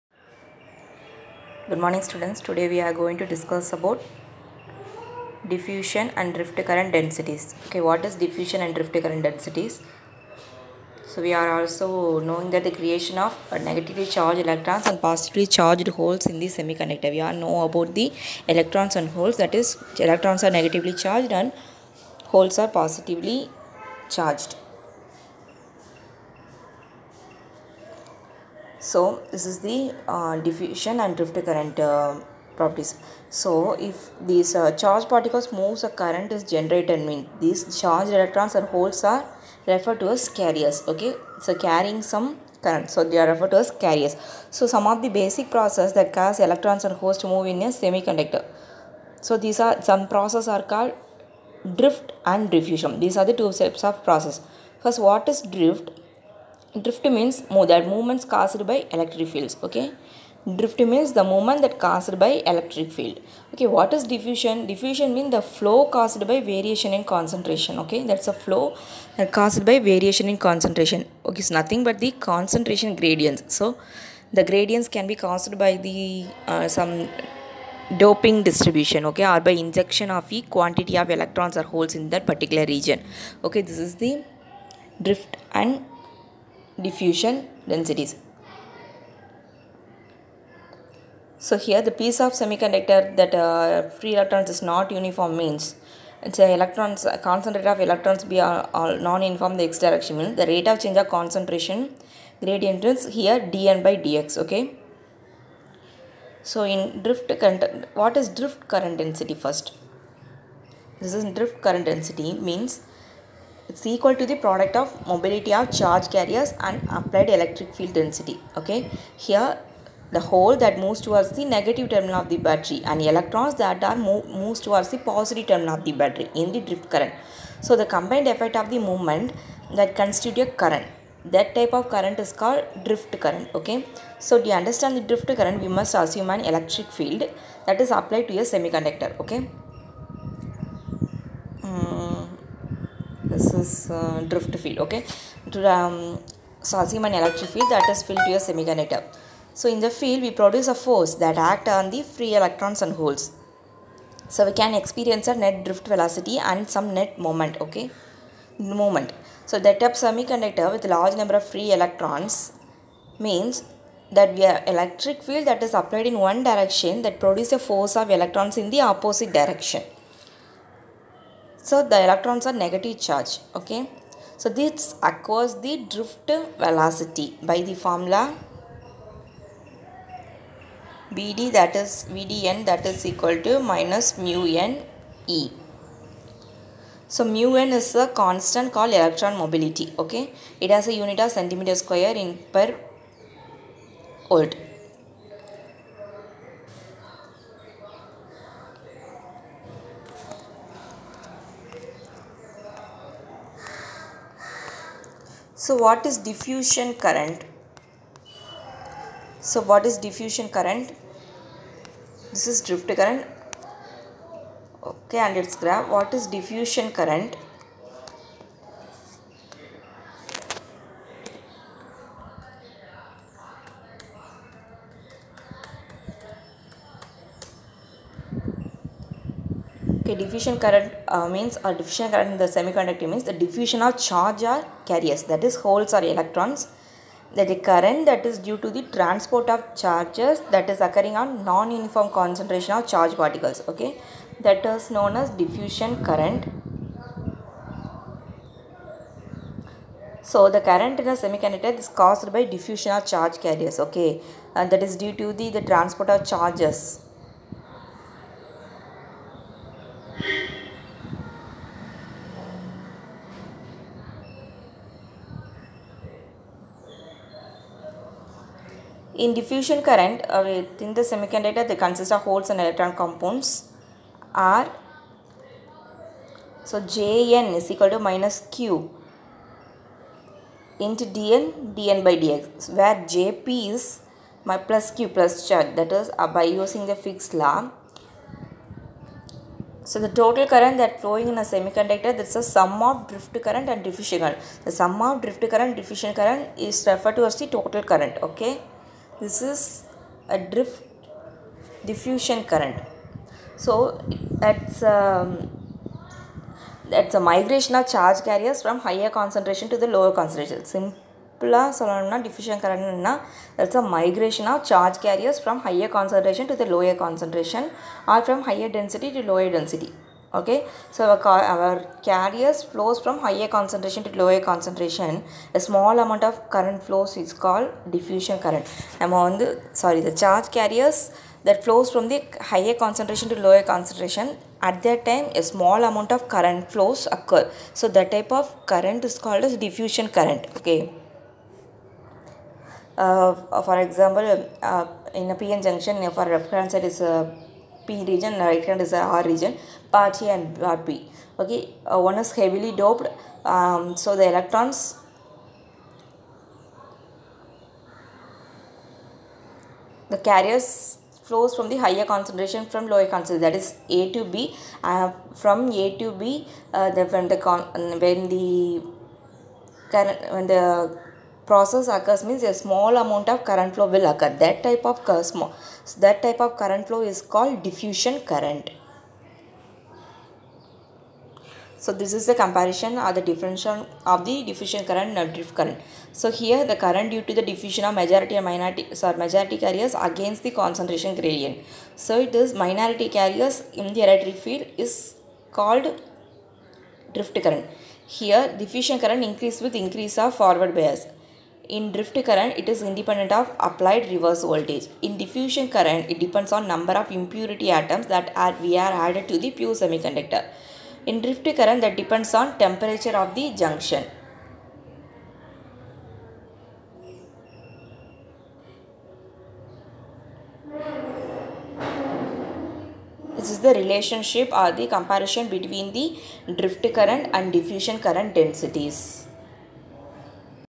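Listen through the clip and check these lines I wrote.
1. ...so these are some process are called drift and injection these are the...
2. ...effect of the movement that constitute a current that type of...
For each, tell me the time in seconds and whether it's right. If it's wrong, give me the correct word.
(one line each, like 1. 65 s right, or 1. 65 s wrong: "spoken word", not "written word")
1. 49 s wrong: "diffusion", not "injection"
2. 128 s right.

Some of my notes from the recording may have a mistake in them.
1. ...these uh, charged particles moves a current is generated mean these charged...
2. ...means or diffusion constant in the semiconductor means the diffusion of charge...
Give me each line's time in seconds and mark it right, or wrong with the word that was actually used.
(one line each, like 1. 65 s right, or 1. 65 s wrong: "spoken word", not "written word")
1. 34 s right
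2. 231 s wrong: "current", not "constant".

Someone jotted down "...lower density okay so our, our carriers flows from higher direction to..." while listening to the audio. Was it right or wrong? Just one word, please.
wrong.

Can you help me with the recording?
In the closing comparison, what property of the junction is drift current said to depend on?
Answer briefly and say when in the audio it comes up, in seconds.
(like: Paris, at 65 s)
temperature, at 412 s.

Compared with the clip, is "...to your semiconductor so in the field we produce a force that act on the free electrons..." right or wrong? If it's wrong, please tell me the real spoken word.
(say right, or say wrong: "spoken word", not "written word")
right.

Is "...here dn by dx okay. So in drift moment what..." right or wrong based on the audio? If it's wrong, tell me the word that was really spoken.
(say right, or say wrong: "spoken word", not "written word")
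wrong: "current", not "moment".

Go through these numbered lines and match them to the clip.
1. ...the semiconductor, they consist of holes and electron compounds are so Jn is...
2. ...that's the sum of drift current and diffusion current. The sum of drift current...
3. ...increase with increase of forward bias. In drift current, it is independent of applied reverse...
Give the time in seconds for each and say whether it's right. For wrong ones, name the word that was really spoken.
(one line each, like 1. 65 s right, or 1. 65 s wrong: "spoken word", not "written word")
1. 270 s right
2. 292 s right
3. 399 s right.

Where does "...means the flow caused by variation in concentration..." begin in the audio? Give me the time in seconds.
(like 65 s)
65 s.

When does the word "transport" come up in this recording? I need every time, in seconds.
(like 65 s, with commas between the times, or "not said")
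238 s, 255 s.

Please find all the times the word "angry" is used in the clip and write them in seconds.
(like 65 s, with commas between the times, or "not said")
not said.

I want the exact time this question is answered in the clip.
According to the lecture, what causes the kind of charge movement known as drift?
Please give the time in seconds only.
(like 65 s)
58 s.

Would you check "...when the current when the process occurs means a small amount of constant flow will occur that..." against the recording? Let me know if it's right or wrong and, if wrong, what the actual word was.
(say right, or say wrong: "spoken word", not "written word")
wrong: "current", not "constant".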